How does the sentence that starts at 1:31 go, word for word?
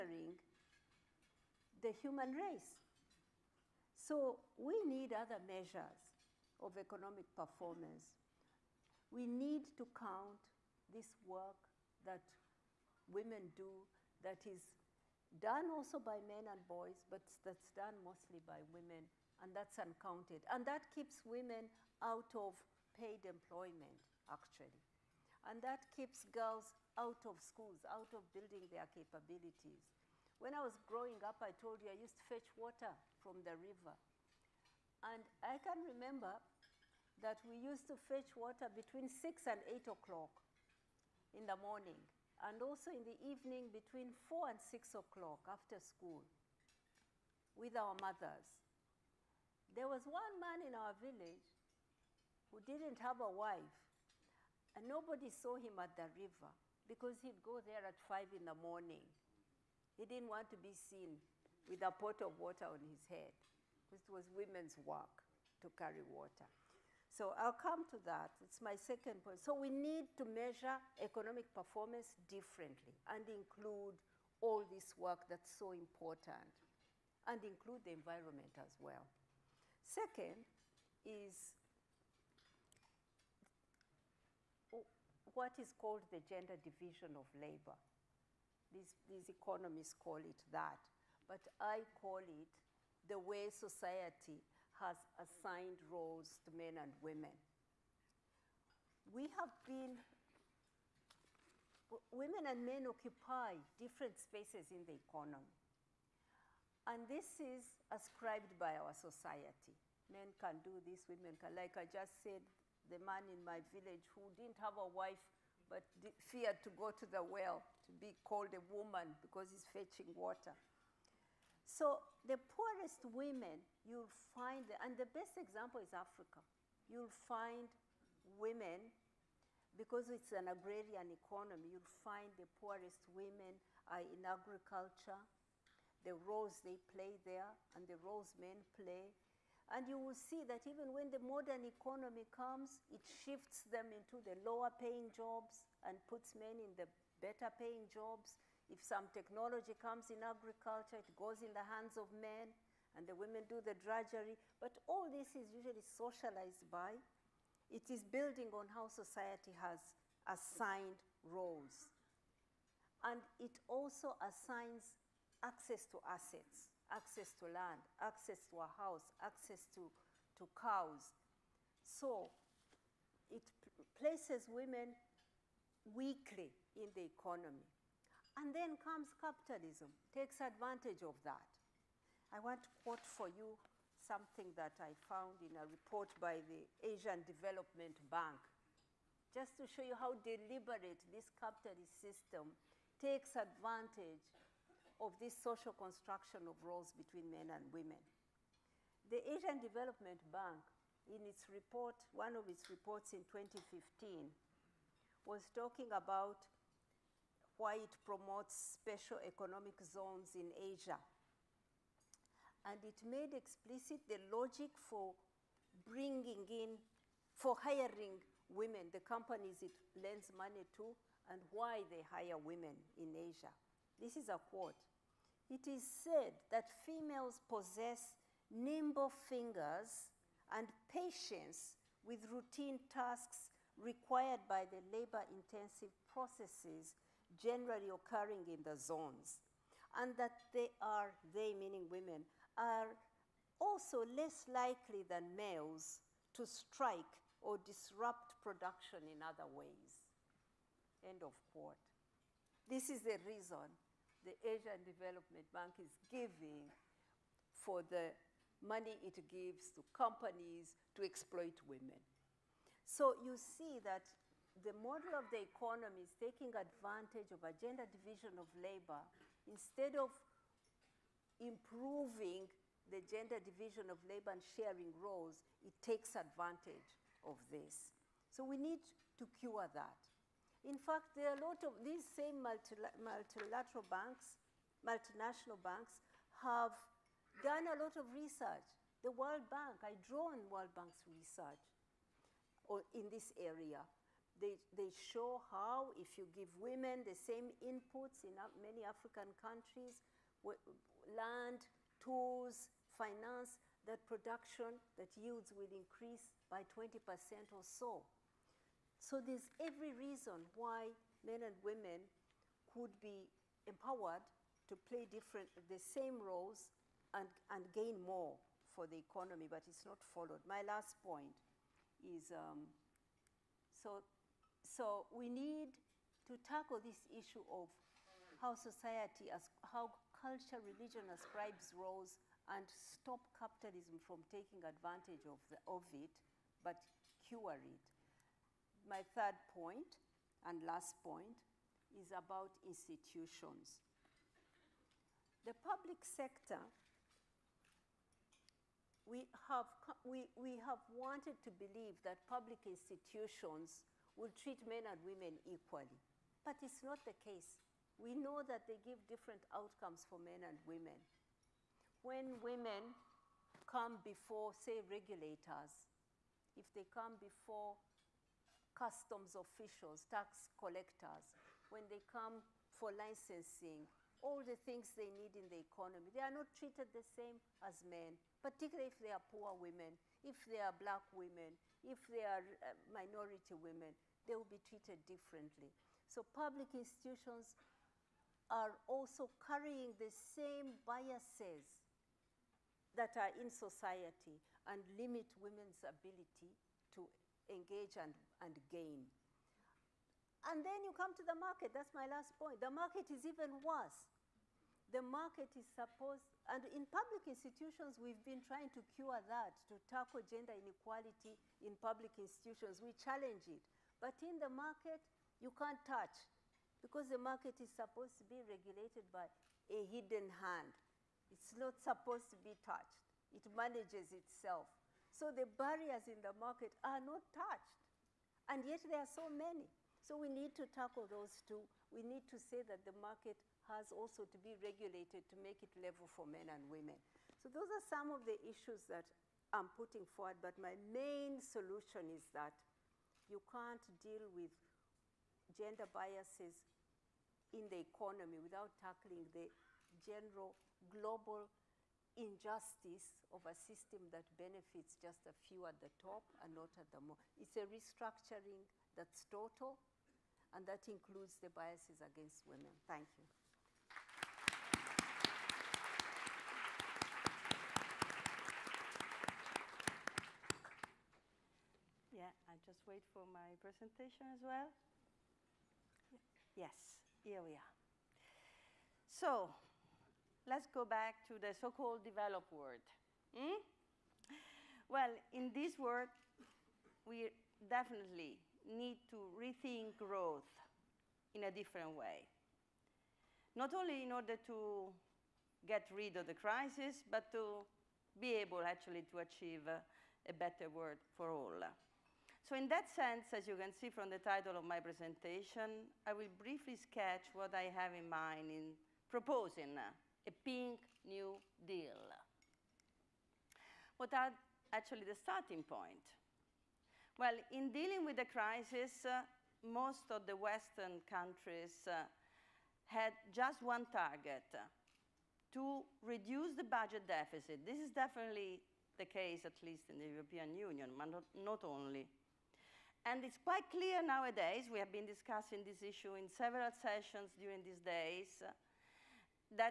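But I call it the way society has assigned roles to men and women.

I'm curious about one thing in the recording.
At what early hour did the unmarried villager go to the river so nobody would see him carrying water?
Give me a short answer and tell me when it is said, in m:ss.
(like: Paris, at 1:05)
5 in the morning, at 0:58.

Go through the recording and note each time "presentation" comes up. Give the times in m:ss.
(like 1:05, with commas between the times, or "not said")
7:53, 8:24.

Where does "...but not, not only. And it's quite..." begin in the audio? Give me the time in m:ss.
8:50.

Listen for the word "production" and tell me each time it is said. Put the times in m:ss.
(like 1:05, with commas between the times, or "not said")
4:08, 5:04.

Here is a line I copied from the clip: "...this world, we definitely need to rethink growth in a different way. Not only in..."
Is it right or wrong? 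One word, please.
right.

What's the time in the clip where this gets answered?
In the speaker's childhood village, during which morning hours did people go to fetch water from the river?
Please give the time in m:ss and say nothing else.
0:38.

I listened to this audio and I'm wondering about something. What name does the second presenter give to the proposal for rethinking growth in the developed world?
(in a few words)
pink new deal.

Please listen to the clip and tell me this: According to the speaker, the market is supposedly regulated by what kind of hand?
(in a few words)
hidden hand.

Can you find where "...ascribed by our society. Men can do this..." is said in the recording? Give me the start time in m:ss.
1:47.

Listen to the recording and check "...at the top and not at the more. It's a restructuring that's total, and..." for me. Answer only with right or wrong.
right.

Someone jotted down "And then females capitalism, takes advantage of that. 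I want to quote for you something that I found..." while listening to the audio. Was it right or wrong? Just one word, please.
wrong.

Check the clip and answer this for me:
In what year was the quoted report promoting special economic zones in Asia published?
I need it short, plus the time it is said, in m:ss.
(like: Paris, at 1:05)
2015, at 3:23.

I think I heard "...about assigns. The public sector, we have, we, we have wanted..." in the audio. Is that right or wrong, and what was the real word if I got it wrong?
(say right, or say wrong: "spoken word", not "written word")
wrong: "institutions", not "assigns".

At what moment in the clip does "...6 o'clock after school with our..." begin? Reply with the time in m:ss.
0:44.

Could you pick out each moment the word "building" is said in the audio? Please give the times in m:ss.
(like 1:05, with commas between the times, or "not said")
0:28, 2:38.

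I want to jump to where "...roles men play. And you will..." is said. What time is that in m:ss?
2:18.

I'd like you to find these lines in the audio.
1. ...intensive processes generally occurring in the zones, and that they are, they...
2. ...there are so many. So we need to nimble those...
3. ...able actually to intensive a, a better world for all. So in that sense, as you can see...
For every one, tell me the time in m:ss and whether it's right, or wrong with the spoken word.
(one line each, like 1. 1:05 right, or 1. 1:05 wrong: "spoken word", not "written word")
1. 3:55 right
2. 7:08 wrong: "tackle", not "nimble"
3. 8:18 wrong: "achieve", not "intensive".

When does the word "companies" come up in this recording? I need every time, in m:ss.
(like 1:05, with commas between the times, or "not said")
3:39, 4:19.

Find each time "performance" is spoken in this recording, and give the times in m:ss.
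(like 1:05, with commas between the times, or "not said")
0:07, 1:11.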